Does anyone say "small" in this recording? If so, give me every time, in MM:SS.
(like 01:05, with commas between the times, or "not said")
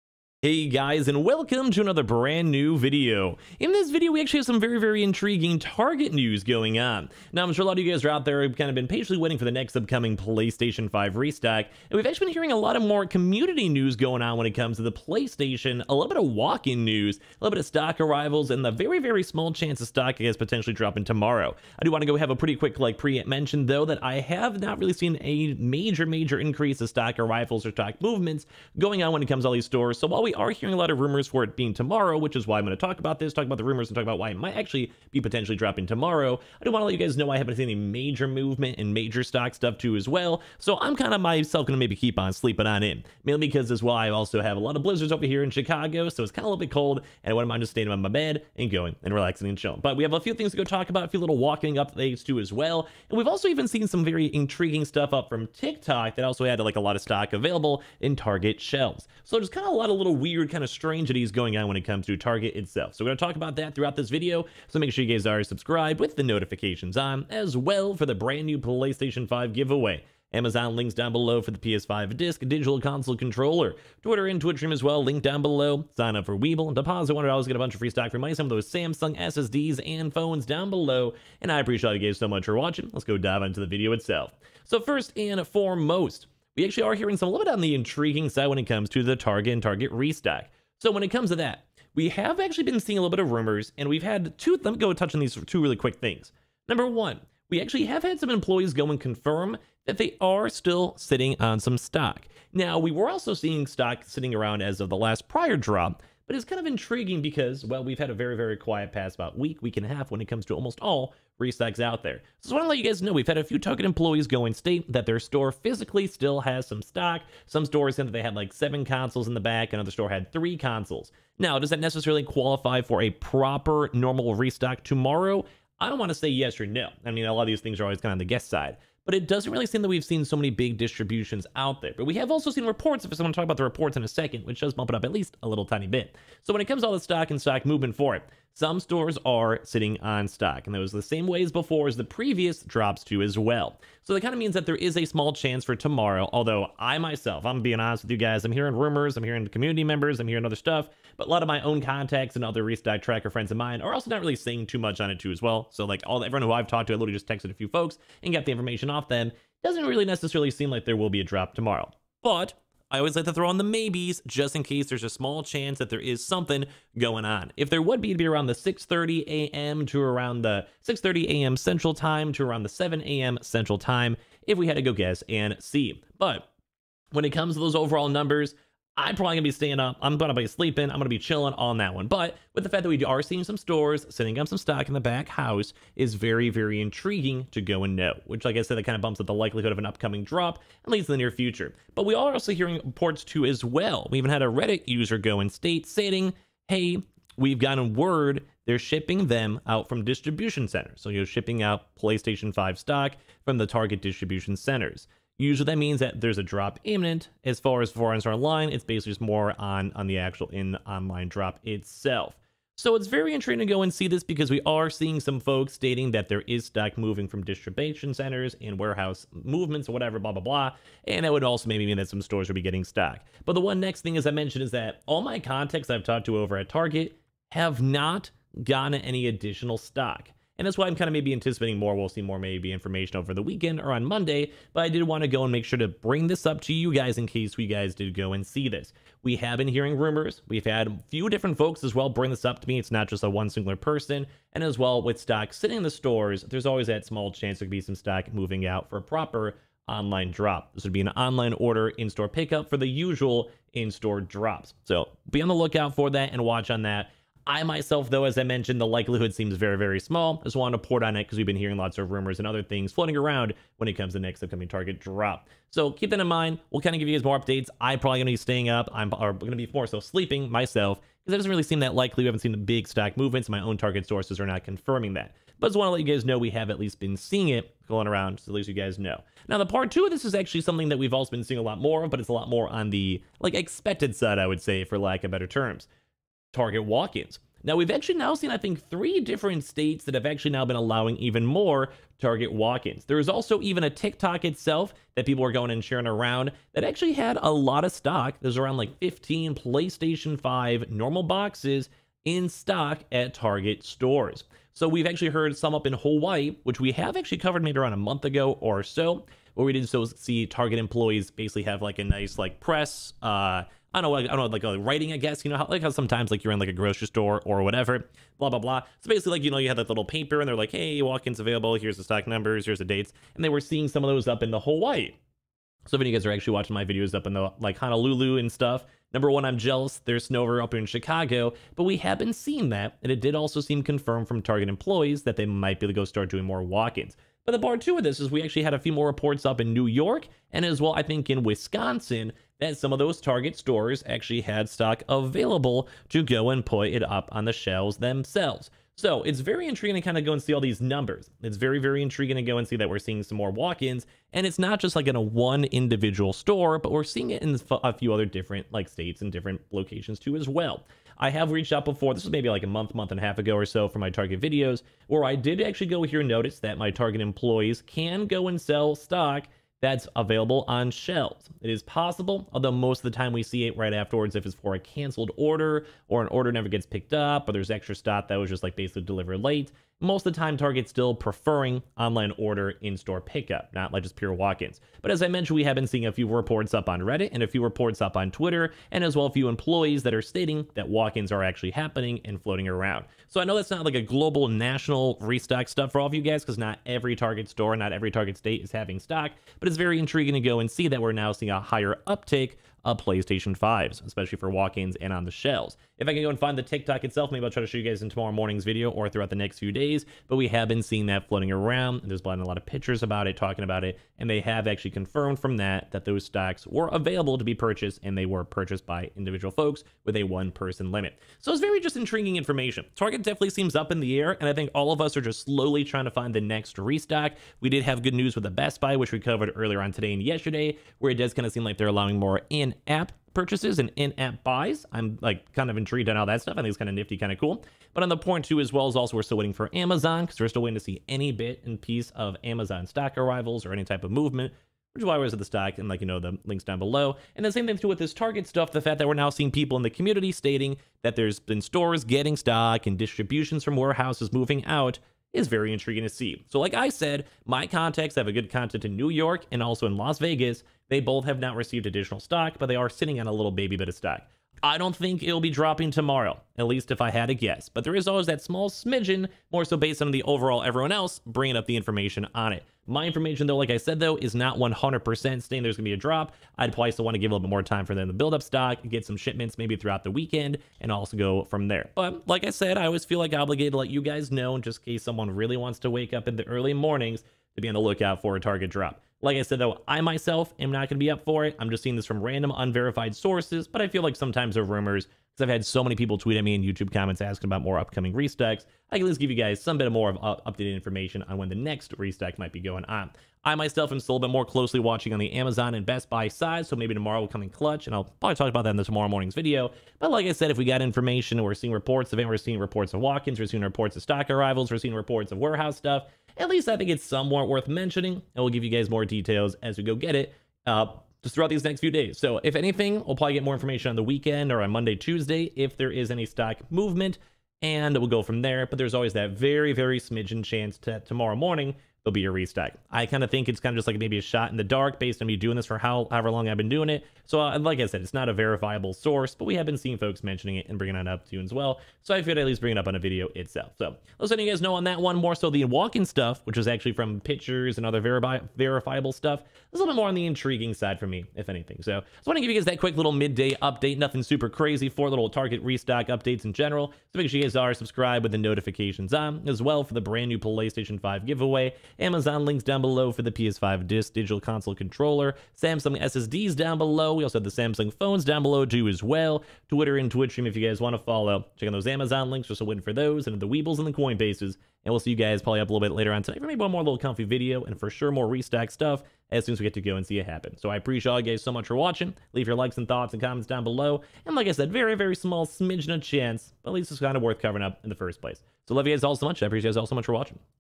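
00:19, 02:25, 02:45, 04:07, 04:19, 07:48, 09:45.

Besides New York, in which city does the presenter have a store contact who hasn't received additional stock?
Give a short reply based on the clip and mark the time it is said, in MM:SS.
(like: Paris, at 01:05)
Las Vegas, at 07:39.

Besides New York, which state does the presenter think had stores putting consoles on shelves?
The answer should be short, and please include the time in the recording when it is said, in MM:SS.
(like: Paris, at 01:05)
Wisconsin, at 05:41.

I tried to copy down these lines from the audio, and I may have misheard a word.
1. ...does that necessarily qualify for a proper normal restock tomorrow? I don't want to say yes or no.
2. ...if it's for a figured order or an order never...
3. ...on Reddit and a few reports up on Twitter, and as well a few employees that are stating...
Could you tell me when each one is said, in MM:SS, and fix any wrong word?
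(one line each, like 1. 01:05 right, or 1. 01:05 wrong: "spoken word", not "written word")
1. 02:01 right
2. 06:14 wrong: "canceled", not "figured"
3. 06:26 right.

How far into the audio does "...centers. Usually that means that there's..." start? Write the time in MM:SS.
03:24.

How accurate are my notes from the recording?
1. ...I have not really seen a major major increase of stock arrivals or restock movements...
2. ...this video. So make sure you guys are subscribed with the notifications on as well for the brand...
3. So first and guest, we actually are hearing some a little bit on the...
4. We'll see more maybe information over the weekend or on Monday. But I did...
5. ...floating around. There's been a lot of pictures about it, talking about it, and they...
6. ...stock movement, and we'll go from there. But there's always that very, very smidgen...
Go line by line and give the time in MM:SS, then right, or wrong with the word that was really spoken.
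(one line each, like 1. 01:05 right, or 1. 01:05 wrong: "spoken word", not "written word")
1. 00:24 wrong: "stock", not "restock"
2. 01:03 right
3. 01:24 wrong: "foremost", not "guest"
4. 03:51 right
5. 06:51 right
6. 08:46 right.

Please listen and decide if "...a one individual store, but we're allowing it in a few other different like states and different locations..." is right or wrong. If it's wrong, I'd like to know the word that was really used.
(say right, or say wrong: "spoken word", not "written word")
wrong: "seeing", not "allowing".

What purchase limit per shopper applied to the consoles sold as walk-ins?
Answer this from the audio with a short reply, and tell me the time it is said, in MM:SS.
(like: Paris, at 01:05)
one-person limit, at 07:00.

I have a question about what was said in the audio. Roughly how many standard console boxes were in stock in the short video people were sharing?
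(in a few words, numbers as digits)
15.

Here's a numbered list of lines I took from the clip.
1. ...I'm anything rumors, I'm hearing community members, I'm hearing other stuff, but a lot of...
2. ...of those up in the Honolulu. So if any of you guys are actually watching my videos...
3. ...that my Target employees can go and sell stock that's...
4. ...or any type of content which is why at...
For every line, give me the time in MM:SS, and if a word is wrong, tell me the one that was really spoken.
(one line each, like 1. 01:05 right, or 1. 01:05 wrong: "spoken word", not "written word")
1. 02:28 wrong: "hearing", not "anything"
2. 05:24 wrong: "Hawaii", not "Honolulu"
3. 06:06 right
4. 07:23 wrong: "movement", not "content".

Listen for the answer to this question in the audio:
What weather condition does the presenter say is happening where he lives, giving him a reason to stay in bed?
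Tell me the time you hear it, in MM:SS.
00:44.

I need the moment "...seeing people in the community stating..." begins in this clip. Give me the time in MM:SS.
07:29.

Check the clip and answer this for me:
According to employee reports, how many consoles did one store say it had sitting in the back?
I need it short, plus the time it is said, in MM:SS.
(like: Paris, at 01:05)
7, at 01:58.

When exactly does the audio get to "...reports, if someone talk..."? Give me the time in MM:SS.
02:12.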